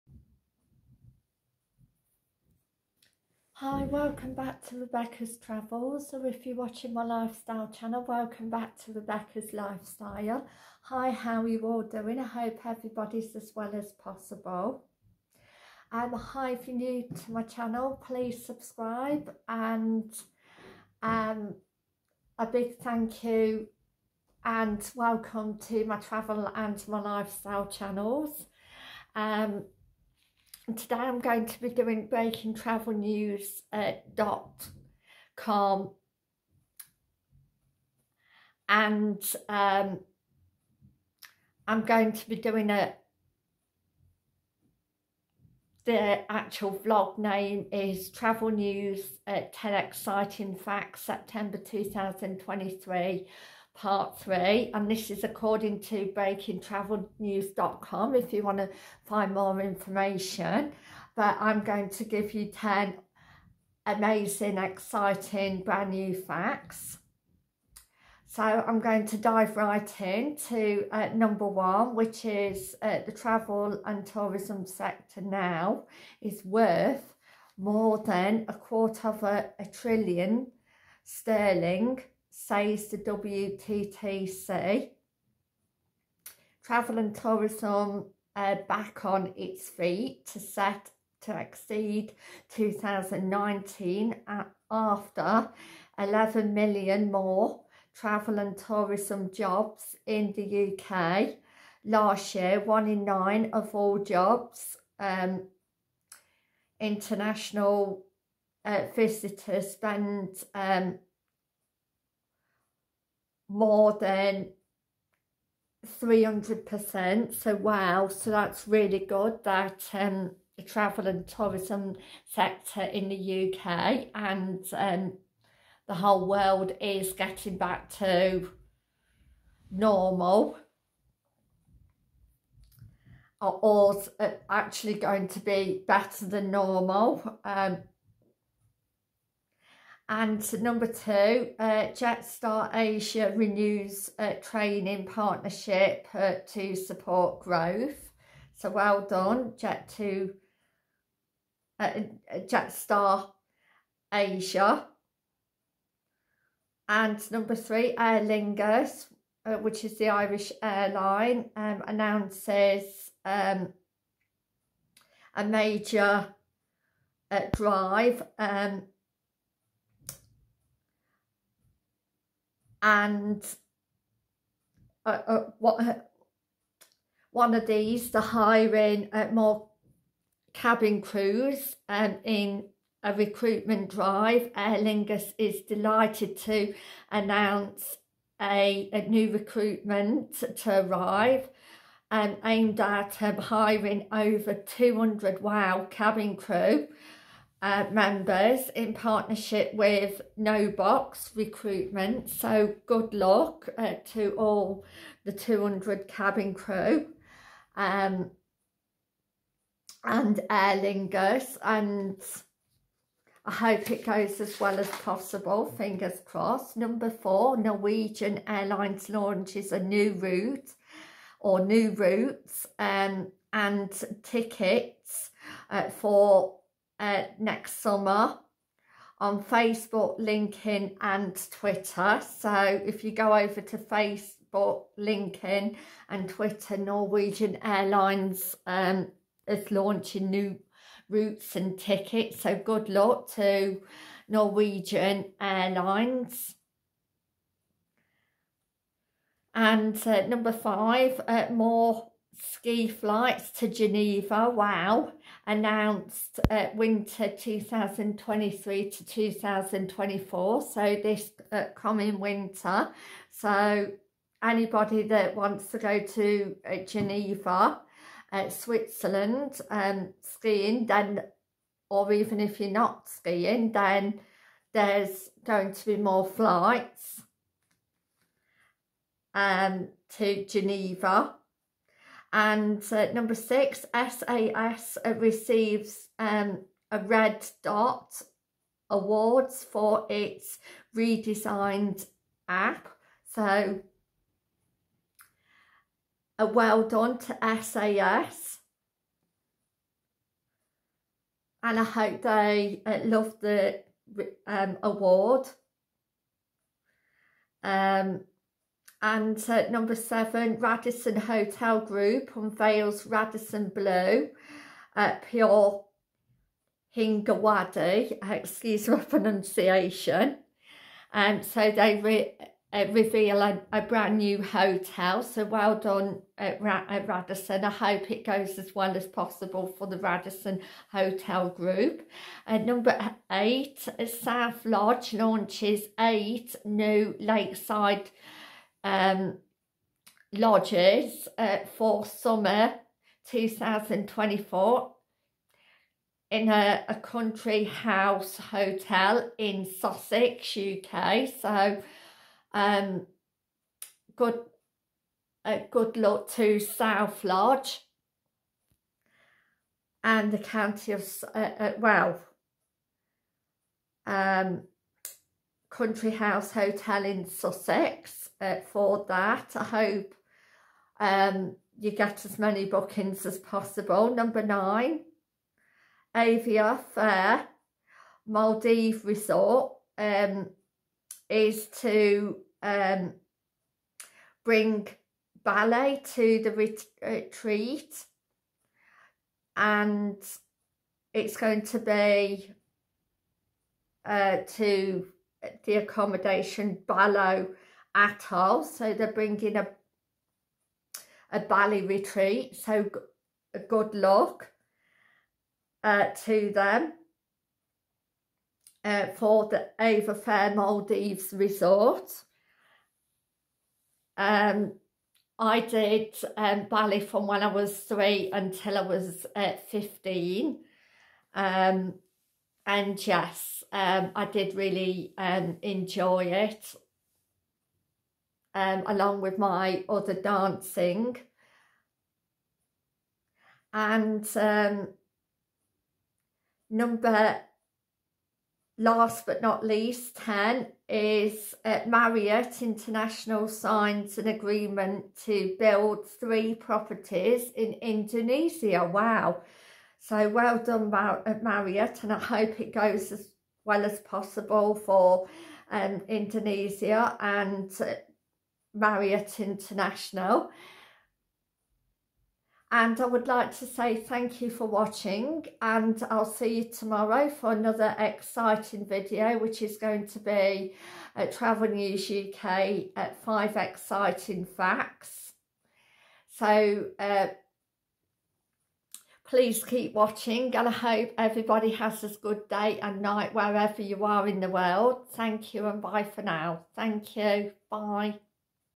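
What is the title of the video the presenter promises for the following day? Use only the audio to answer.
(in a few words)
Travel News UK at 5 Exciting Facts.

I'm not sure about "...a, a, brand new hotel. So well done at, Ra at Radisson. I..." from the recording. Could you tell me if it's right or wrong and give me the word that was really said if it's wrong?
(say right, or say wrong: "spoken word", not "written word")
right.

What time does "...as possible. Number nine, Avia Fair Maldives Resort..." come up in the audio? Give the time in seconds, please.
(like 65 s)
373 s.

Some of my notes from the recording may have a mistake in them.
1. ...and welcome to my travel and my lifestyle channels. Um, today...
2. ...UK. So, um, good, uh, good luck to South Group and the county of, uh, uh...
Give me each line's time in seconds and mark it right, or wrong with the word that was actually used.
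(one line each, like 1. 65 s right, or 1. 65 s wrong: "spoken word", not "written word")
1. 24 s right
2. 350 s wrong: "Lodge", not "Group".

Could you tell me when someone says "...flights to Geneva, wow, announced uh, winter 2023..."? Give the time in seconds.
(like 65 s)
252 s.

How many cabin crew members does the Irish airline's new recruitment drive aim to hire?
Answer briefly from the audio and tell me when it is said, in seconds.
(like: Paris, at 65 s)
over 200, at 194 s.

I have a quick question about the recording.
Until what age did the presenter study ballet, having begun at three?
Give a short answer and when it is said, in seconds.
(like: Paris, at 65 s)
15, at 419 s.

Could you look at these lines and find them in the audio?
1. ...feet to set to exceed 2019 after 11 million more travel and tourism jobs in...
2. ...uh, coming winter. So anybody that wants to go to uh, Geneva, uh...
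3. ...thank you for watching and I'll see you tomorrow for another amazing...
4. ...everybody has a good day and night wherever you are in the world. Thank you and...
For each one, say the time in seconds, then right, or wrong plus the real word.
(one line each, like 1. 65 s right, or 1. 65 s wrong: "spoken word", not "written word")
1. 89 s right
2. 261 s right
3. 463 s wrong: "exciting", not "amazing"
4. 481 s right.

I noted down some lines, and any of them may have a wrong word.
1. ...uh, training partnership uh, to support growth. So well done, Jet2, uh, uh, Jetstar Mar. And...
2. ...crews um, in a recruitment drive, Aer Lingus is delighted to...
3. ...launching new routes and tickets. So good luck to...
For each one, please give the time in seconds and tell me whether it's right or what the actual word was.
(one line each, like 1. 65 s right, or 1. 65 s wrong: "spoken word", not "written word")
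1. 144 s wrong: "Asia", not "Mar"
2. 181 s right
3. 239 s right.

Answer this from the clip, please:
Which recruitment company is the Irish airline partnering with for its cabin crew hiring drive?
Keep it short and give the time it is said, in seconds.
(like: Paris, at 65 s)
No Box Recruitment, at 200 s.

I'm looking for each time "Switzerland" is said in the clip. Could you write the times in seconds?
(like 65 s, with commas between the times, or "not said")
268 s.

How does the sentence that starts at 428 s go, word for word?
Um, along with my other dancing.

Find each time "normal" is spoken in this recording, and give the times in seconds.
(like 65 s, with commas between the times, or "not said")
129 s, 136 s.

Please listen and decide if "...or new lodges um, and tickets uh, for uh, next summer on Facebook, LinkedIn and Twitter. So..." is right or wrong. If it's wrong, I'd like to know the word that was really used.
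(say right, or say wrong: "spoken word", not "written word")
wrong: "routes", not "lodges".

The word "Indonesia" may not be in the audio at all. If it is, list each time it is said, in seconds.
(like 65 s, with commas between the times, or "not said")
447 s, 456 s.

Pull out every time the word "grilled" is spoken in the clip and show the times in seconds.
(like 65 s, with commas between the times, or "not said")
not said.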